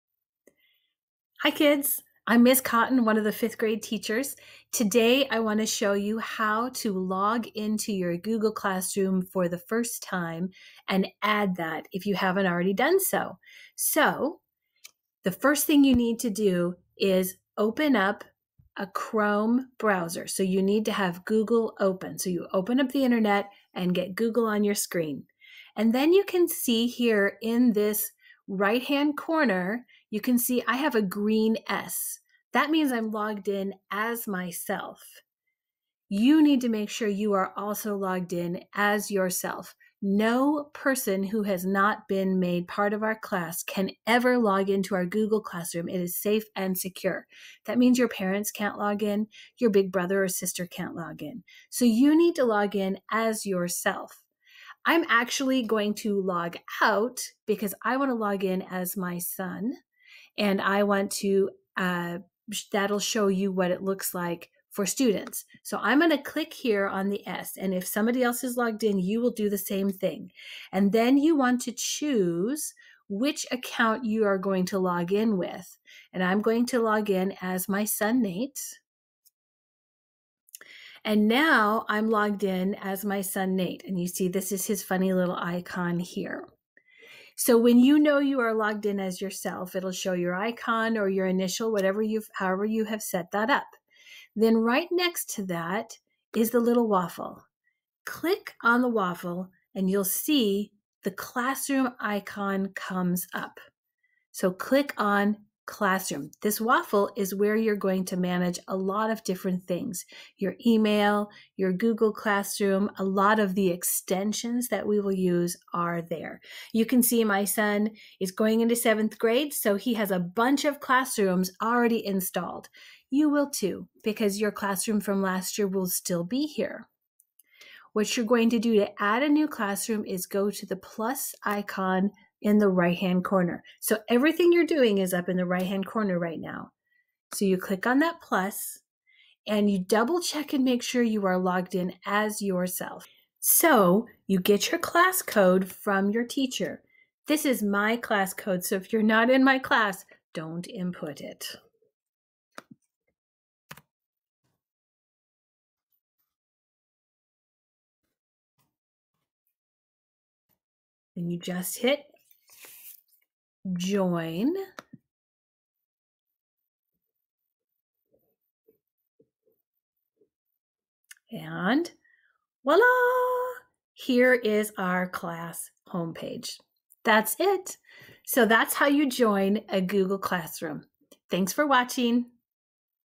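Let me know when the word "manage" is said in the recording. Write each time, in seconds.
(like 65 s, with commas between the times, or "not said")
108 s.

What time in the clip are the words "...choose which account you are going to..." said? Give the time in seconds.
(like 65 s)
71 s.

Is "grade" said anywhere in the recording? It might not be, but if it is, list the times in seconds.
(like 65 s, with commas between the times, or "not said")
3 s, 119 s.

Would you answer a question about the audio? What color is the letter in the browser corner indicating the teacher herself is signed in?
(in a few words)
Green.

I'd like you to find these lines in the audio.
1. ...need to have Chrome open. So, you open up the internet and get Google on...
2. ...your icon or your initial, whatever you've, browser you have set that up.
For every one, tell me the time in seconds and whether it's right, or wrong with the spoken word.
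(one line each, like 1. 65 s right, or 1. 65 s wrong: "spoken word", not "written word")
1. 20 s wrong: "Google", not "Chrome"
2. 90 s wrong: "however", not "browser".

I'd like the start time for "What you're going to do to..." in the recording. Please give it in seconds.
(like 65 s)
127 s.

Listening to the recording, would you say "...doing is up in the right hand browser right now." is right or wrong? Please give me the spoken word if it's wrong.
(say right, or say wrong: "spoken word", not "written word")
wrong: "corner", not "browser".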